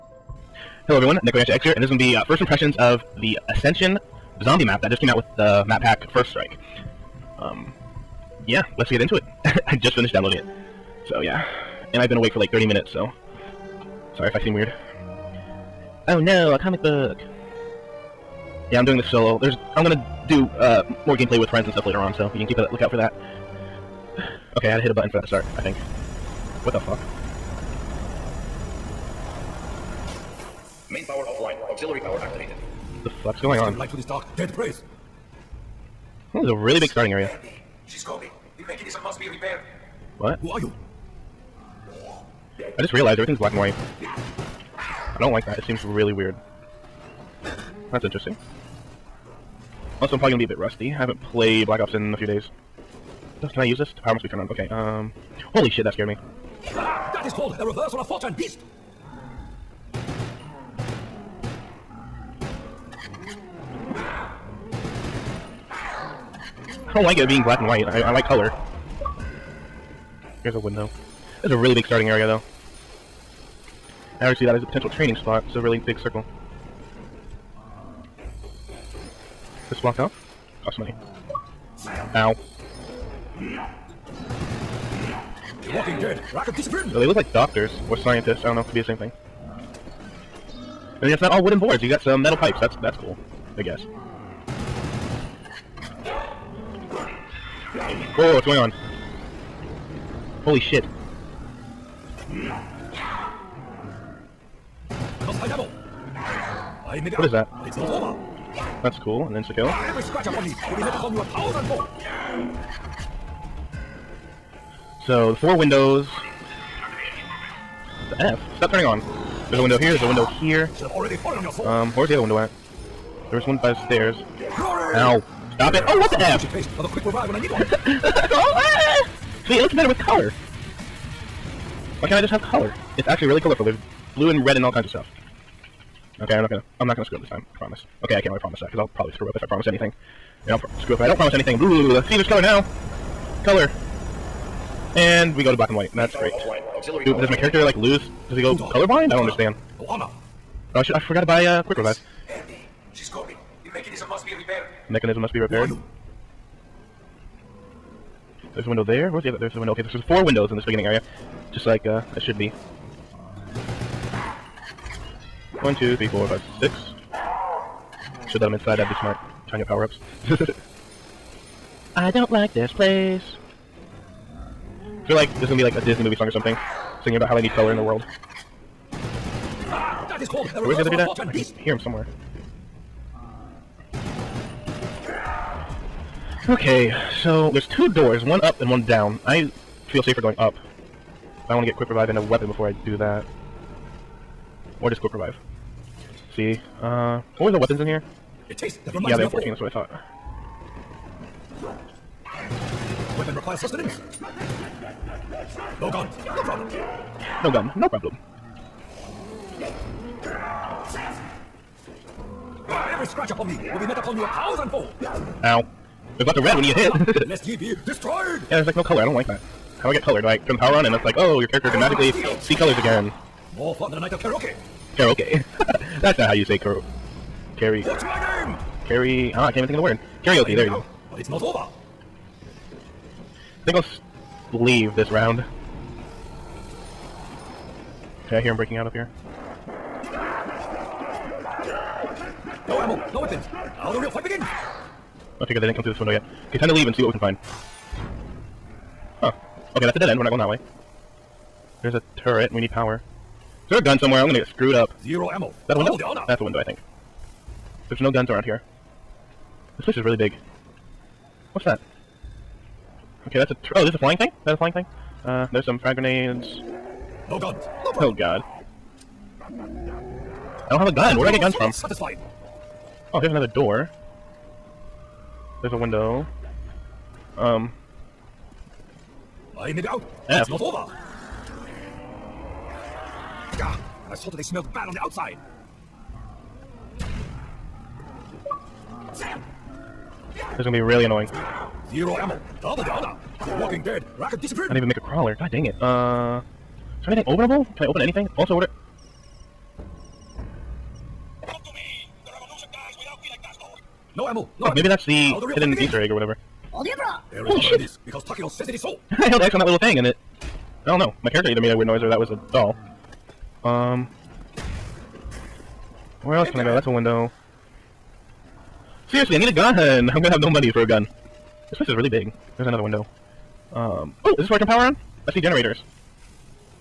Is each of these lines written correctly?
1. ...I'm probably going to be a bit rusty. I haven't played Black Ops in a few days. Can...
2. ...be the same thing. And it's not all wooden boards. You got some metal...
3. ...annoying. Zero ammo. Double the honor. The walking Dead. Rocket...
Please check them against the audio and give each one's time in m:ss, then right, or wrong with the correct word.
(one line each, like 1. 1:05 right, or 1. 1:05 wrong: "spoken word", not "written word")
1. 0:50 right
2. 1:28 right
3. 4:51 right.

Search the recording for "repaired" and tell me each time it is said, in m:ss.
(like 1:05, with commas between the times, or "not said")
0:39, 2:35.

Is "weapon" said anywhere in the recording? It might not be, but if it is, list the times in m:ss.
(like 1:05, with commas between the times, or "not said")
3:12, 3:17, 3:23, 4:03.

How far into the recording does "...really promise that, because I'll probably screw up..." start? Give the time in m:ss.
2:18.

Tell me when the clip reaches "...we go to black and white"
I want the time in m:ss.
2:25.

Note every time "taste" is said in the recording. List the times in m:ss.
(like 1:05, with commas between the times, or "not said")
2:06, 3:18.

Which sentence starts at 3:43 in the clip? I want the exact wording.
More fun than a night of karaoke.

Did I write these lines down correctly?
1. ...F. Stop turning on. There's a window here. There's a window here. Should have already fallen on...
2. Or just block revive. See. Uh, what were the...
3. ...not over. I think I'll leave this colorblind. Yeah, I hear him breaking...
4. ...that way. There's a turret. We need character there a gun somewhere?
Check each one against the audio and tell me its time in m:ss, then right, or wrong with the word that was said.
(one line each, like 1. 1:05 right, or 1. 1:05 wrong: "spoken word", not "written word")
1. 1:58 right
2. 3:14 wrong: "quick", not "block"
3. 3:51 wrong: "round", not "colorblind"
4. 4:10 wrong: "power", not "character".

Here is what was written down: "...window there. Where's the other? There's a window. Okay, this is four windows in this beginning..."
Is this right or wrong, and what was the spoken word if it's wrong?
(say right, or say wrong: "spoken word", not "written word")
right.